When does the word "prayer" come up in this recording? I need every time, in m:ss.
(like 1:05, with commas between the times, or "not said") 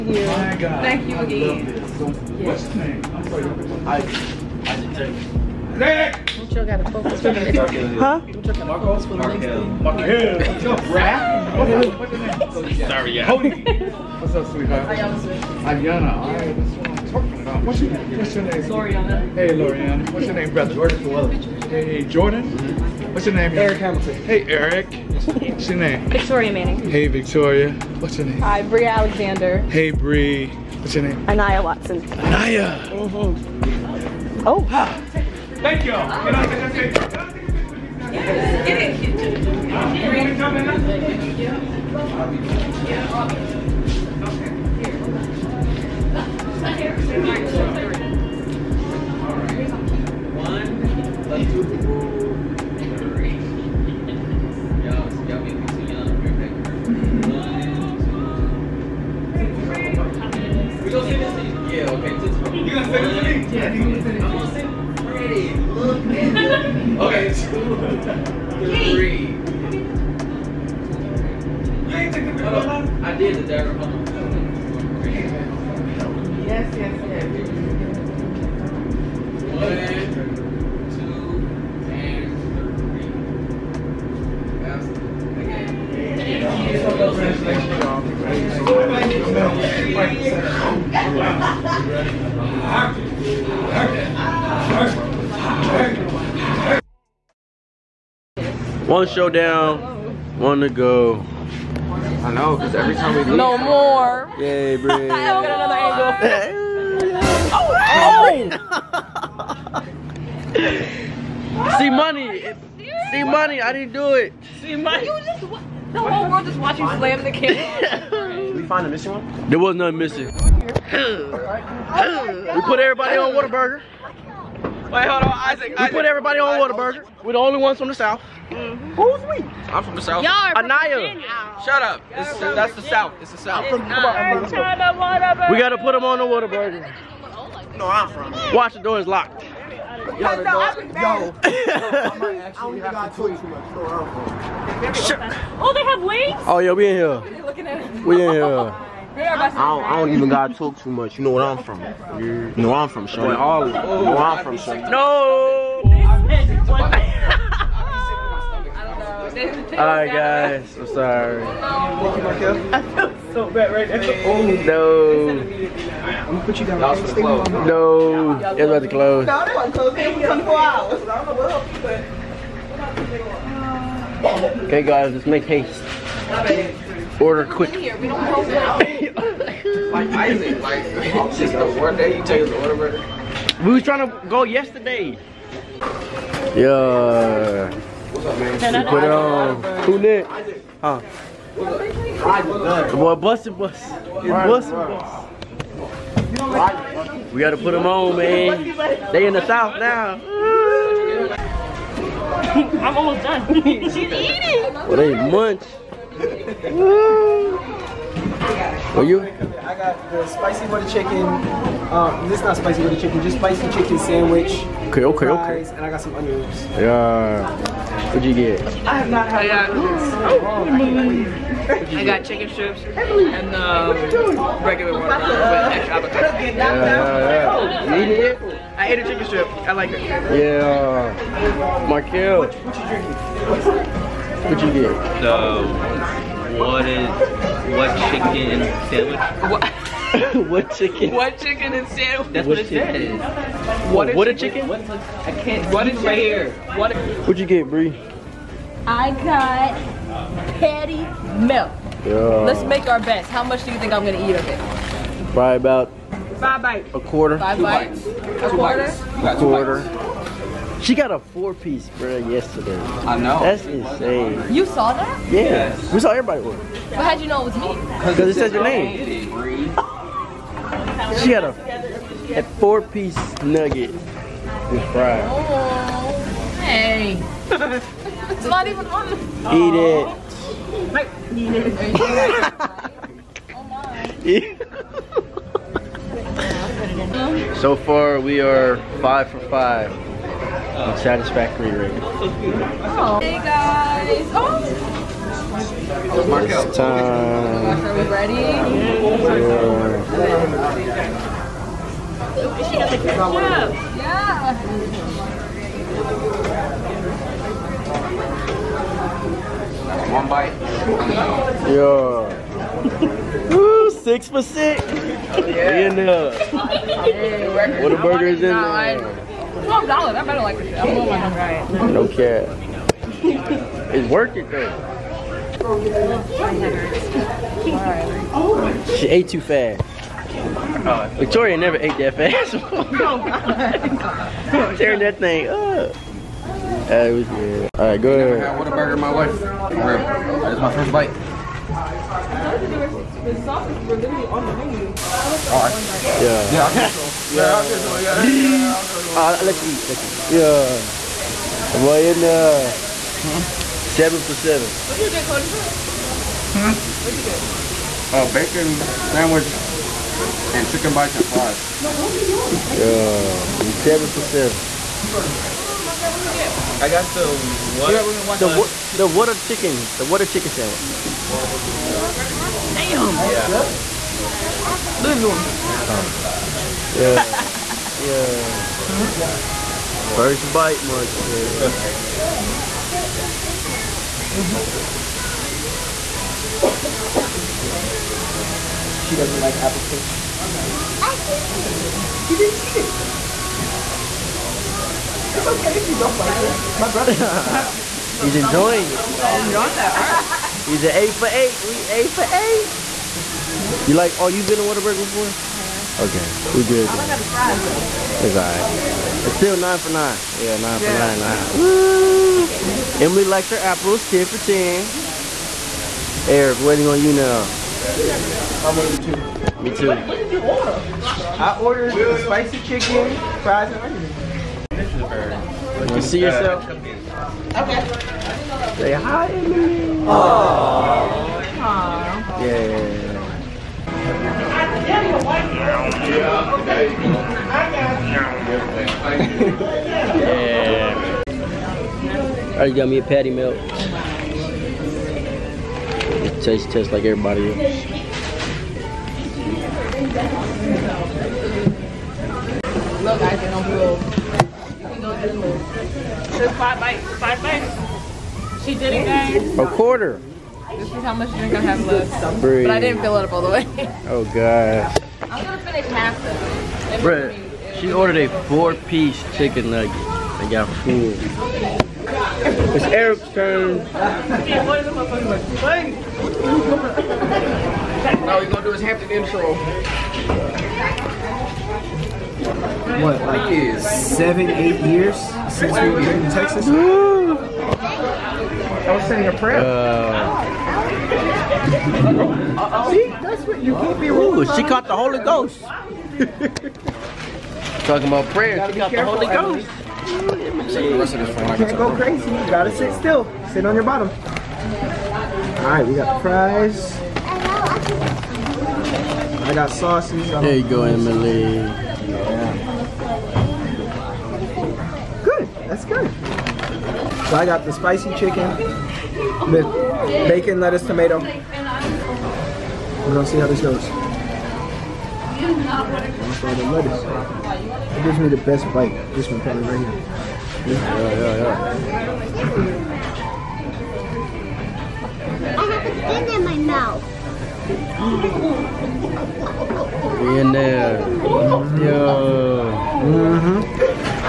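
8:09, 8:18.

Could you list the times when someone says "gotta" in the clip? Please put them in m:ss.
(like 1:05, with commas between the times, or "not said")
2:15, 2:30, 3:17, 8:22.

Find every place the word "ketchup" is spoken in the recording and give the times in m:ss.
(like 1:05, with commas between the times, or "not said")
5:02.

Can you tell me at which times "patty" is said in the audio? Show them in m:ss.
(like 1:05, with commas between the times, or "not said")
4:10, 7:23.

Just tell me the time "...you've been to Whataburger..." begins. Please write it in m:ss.
6:44.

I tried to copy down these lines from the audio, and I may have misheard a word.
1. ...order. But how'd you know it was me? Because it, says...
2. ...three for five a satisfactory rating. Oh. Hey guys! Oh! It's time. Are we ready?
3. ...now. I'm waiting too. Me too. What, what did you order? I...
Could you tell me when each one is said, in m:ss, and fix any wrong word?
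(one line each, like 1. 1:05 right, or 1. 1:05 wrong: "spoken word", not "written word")
1. 4:26 right
2. 4:49 wrong: "five", not "three"
3. 6:57 right.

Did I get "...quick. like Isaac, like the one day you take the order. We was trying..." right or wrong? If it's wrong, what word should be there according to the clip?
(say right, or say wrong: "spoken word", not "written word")
right.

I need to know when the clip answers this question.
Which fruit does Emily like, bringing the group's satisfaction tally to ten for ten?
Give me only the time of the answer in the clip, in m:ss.
6:53.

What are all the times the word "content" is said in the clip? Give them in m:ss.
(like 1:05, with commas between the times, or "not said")
not said.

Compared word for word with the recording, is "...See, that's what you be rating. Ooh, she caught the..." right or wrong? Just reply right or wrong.
wrong.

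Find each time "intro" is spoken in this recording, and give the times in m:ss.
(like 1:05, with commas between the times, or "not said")
7:59.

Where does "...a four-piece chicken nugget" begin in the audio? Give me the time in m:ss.
7:48.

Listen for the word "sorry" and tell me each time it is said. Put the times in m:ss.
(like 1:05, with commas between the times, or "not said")
0:03, 2:40.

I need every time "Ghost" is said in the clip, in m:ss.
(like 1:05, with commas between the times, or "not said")
8:15, 8:19.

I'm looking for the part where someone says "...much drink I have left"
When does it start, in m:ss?
7:41.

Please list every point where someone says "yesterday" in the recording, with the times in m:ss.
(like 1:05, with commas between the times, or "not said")
3:04, 4:22.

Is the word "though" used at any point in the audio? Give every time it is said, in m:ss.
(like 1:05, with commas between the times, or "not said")
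5:24, 6:47.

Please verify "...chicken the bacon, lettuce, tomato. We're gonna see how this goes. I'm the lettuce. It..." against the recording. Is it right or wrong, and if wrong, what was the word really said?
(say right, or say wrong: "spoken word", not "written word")
right.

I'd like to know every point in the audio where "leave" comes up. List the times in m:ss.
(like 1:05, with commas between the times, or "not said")
1:43.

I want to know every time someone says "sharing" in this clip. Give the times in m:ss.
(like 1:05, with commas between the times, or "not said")
not said.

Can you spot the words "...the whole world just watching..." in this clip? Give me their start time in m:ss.
1:55.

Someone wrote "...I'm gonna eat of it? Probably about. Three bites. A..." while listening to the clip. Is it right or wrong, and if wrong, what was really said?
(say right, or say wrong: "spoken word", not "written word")
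wrong: "Five", not "Three".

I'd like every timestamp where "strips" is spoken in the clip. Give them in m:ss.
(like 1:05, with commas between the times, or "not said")
3:42, 3:49.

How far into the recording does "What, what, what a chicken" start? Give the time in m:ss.
4:03.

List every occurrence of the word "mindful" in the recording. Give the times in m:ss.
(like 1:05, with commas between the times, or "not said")
not said.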